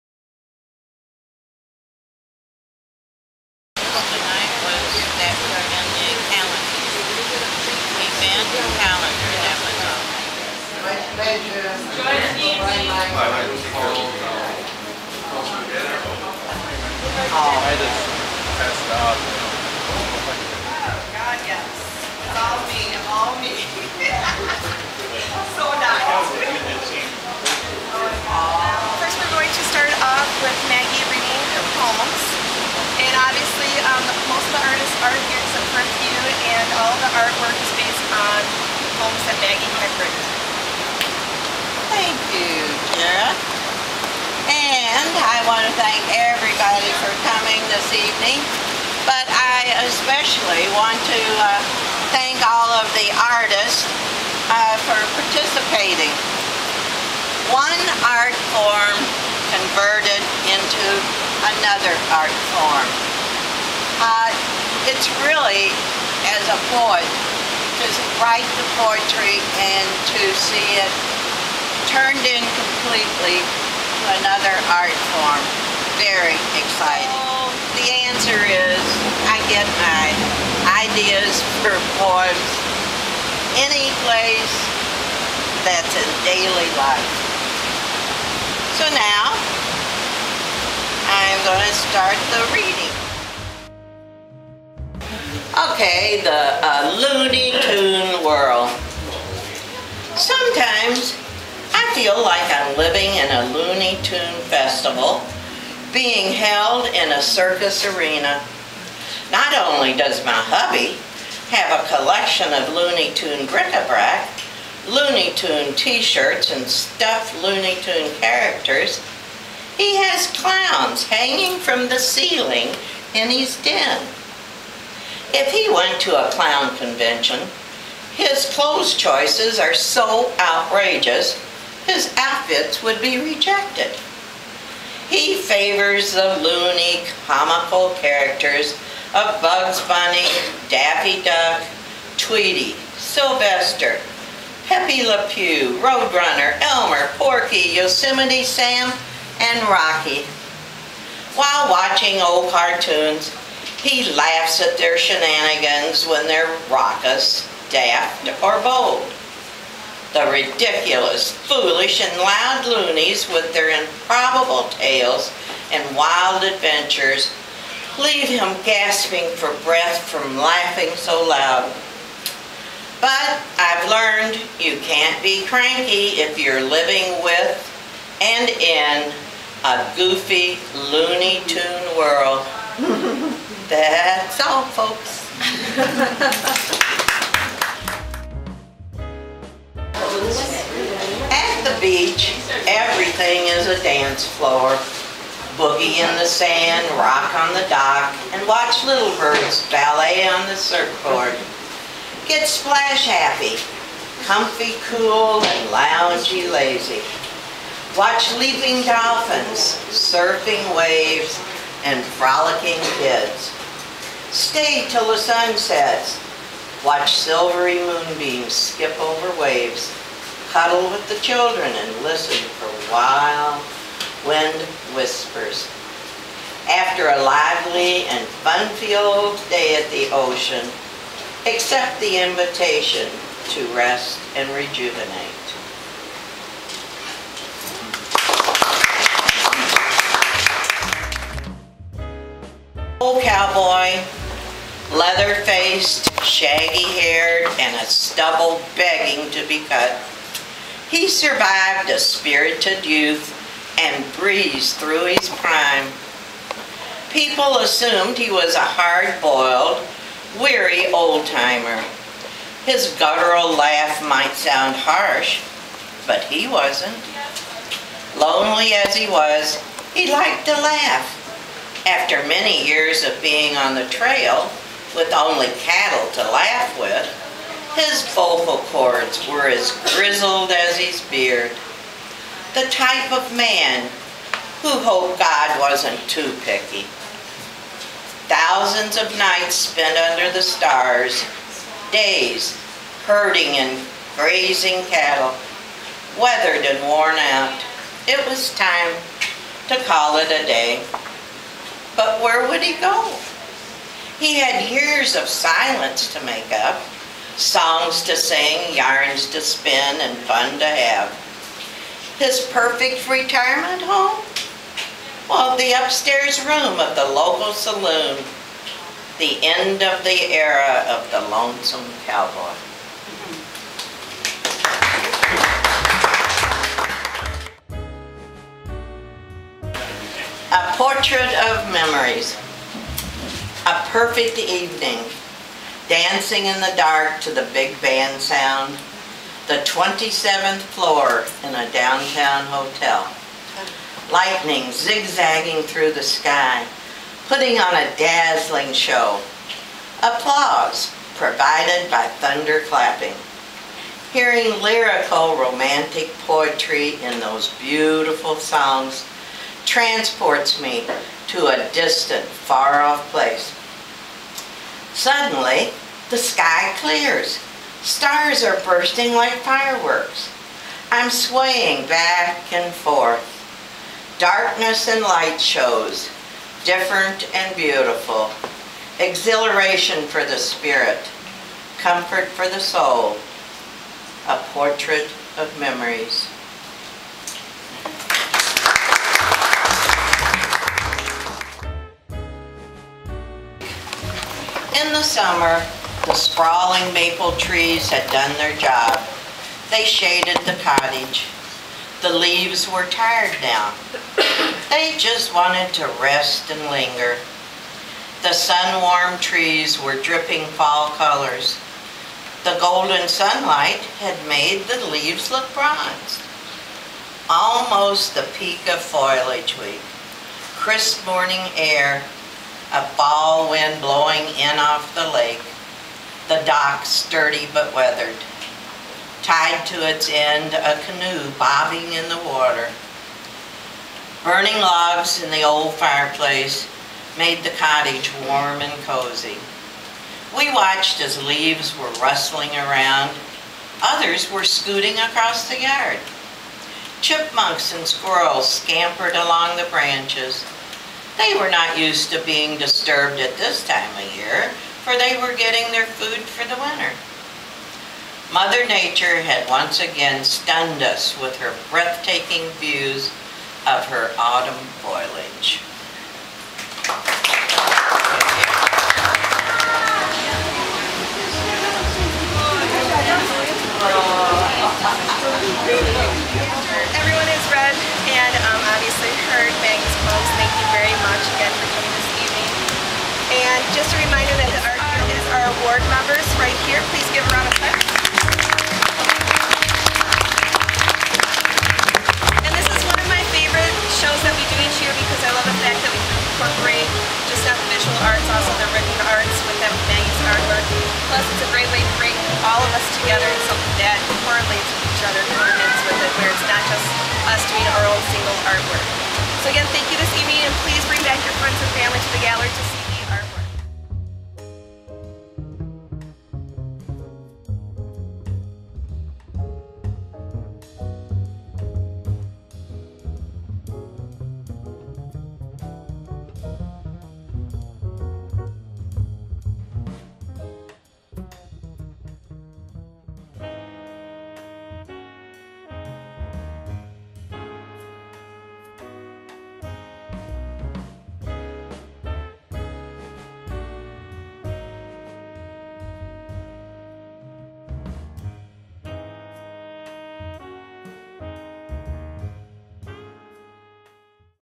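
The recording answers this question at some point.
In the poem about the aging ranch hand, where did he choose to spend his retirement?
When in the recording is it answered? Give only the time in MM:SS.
05:15.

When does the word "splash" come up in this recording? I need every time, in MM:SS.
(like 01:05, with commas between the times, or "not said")
03:22.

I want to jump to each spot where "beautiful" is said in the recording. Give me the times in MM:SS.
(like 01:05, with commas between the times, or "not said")
05:57, 06:17.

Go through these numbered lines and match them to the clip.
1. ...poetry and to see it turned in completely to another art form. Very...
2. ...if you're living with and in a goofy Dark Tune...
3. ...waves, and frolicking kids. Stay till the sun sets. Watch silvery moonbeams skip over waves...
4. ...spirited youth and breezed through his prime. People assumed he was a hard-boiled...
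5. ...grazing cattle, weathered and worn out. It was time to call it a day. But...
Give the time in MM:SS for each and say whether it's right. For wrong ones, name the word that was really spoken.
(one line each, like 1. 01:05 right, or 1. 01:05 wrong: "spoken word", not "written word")
1. 01:08 right
2. 02:56 wrong: "Looney", not "Dark"
3. 03:30 right
4. 04:11 right
5. 04:54 right.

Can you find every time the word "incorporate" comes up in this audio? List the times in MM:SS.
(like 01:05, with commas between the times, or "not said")
08:16.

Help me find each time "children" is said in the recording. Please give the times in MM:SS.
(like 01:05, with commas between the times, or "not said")
03:41.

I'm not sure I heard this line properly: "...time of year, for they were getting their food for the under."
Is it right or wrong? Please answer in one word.
wrong.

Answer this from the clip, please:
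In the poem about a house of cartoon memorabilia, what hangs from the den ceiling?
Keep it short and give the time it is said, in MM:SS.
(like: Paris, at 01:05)
Clowns, at 02:00.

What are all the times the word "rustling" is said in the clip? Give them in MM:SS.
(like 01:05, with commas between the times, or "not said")
07:22.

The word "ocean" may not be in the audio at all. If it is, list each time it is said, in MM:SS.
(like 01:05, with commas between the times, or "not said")
03:50.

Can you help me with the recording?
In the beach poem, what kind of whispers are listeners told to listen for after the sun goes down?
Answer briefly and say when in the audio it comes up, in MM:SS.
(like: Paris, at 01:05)
Wild wind whispers, at 03:42.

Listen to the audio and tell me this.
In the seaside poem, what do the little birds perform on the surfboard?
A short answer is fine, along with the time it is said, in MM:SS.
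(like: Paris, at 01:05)
Ballet, at 03:19.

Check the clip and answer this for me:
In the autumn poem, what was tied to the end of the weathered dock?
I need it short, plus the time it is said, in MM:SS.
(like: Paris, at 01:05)
A canoe, at 07:10.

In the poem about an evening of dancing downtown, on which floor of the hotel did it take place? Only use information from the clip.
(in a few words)
27th floor.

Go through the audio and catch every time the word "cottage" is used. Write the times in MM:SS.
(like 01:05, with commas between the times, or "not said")
06:40, 07:17.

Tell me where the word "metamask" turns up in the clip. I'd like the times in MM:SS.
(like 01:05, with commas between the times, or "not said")
not said.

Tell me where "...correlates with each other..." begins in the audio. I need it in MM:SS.
08:24.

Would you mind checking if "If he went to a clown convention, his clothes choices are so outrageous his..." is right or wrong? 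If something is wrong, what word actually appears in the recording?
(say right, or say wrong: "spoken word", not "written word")
right.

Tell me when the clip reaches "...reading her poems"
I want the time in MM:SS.
00:31.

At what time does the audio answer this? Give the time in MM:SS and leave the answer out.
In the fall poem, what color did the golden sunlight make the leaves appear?
06:55.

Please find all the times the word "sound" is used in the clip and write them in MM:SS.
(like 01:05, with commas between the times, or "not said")
04:24, 05:38.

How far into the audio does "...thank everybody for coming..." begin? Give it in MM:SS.
00:45.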